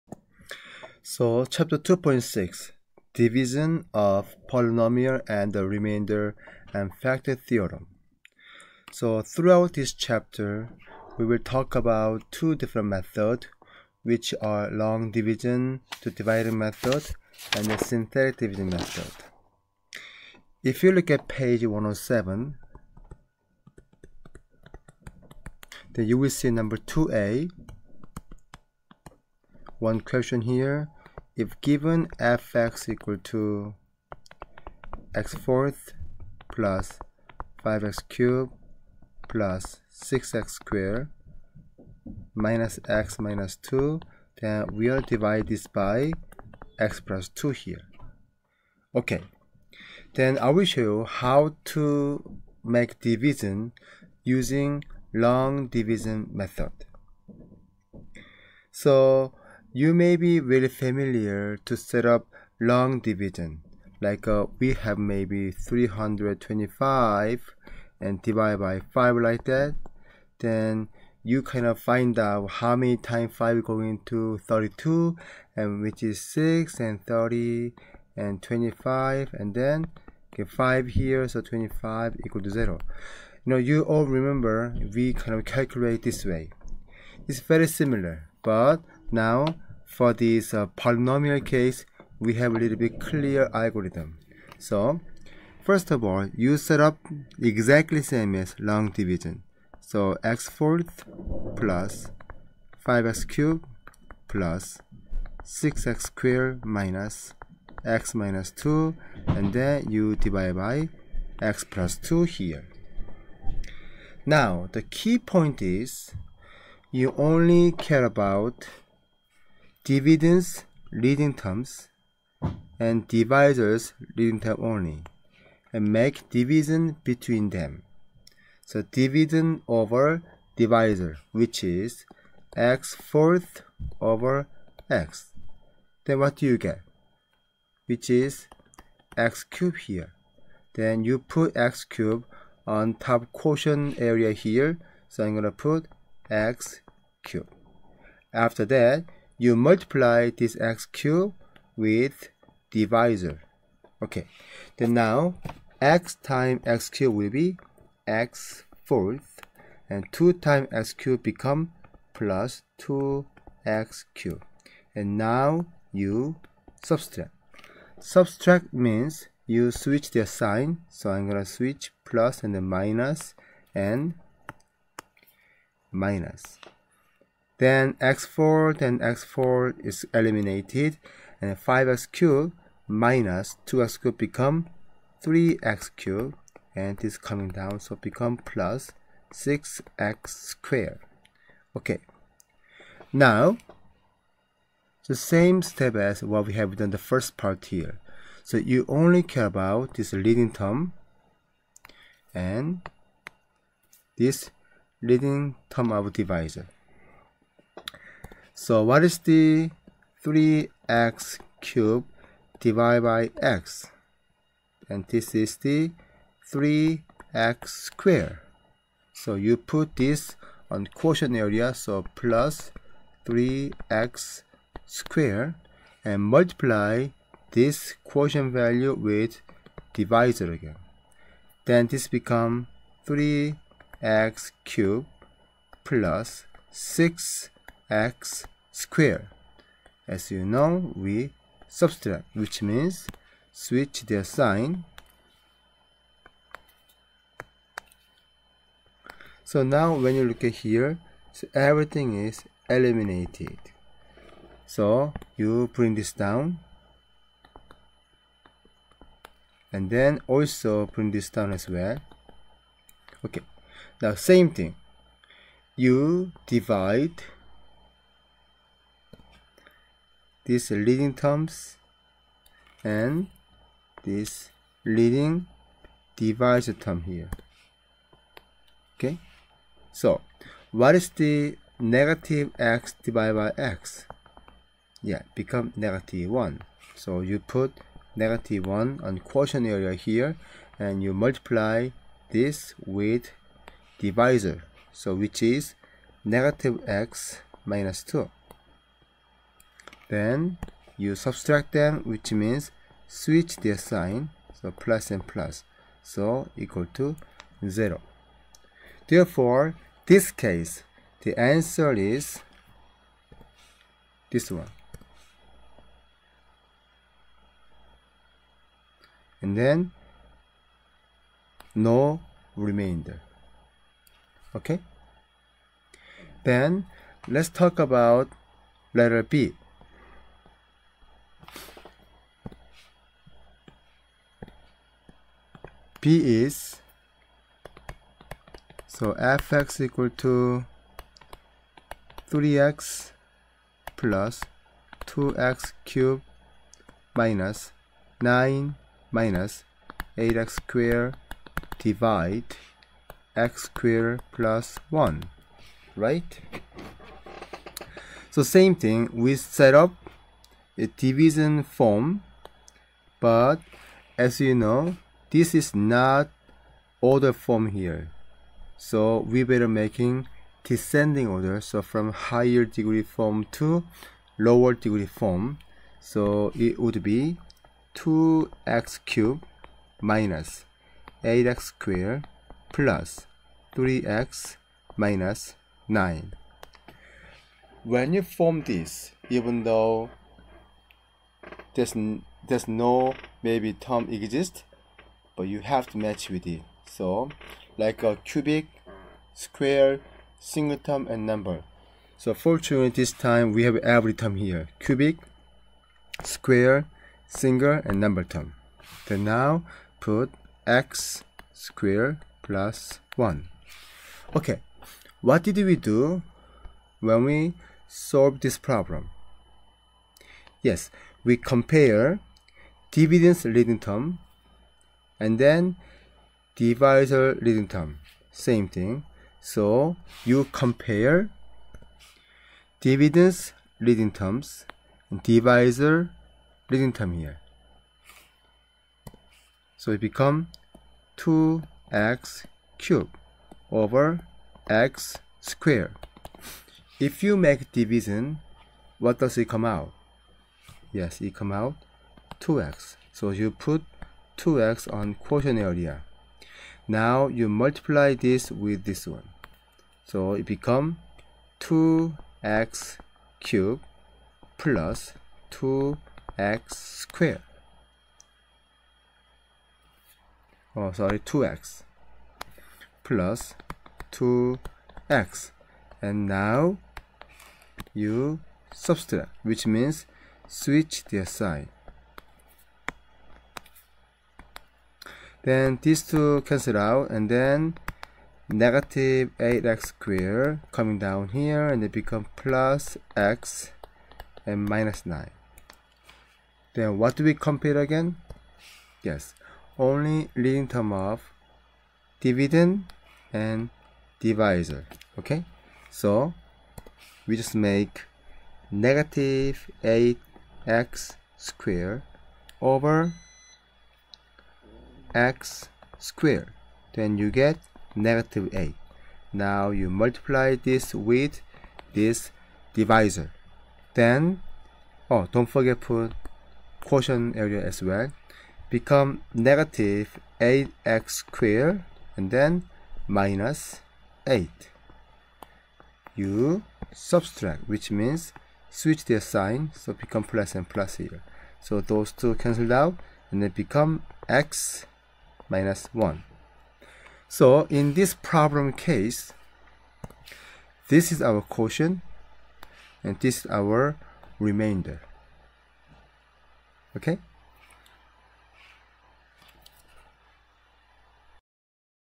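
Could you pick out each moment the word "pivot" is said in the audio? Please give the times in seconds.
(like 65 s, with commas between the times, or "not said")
not said.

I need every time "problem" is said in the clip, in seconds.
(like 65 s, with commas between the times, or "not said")
418 s, 548 s.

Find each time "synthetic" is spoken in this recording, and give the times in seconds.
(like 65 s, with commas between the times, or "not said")
17 s.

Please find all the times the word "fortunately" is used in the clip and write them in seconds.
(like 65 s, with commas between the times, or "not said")
402 s.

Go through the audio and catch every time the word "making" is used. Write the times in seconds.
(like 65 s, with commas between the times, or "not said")
369 s.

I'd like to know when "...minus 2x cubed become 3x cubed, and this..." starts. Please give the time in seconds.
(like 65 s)
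182 s.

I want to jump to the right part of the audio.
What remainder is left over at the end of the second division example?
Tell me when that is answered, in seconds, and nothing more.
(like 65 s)
544 s.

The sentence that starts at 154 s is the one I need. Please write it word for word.
Okay, then now x times x cube will be x fourth and 2 times x cube become plus 2x cube.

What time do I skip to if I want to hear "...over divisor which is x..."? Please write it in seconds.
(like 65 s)
129 s.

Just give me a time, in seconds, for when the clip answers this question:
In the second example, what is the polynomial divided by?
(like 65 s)
353 s.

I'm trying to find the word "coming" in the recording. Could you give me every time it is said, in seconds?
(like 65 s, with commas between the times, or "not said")
187 s, 490 s.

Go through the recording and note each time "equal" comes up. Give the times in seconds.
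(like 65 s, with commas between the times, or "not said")
32 s, 82 s, 306 s, 339 s.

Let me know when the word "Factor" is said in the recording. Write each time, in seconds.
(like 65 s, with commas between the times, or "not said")
7 s.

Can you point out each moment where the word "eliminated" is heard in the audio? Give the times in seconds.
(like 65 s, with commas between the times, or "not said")
180 s, 252 s.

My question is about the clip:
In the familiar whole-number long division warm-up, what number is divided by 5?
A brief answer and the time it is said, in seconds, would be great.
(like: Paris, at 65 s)
325, at 65 s.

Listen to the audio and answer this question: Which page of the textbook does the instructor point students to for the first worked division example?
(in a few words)
107.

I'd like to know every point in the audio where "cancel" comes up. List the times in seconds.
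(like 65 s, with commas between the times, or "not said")
486 s, 542 s.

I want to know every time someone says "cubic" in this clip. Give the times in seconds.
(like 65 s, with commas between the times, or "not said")
398 s, 404 s.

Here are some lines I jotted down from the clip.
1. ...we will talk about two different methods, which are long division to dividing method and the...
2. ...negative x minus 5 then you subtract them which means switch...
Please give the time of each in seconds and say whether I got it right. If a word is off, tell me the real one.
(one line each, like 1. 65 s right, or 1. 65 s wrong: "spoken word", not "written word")
1. 11 s right
2. 296 s wrong: "2", not "5".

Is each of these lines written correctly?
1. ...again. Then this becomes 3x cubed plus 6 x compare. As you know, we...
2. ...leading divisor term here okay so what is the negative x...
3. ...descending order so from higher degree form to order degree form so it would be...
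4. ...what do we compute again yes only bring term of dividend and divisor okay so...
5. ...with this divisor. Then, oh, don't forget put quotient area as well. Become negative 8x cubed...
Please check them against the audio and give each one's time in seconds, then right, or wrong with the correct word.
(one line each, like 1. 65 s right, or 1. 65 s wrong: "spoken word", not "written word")
1. 230 s wrong: "square", not "compare"
2. 274 s right
3. 370 s wrong: "lower", not "order"
4. 496 s wrong: "leading", not "bring"
5. 520 s wrong: "squared", not "cubed".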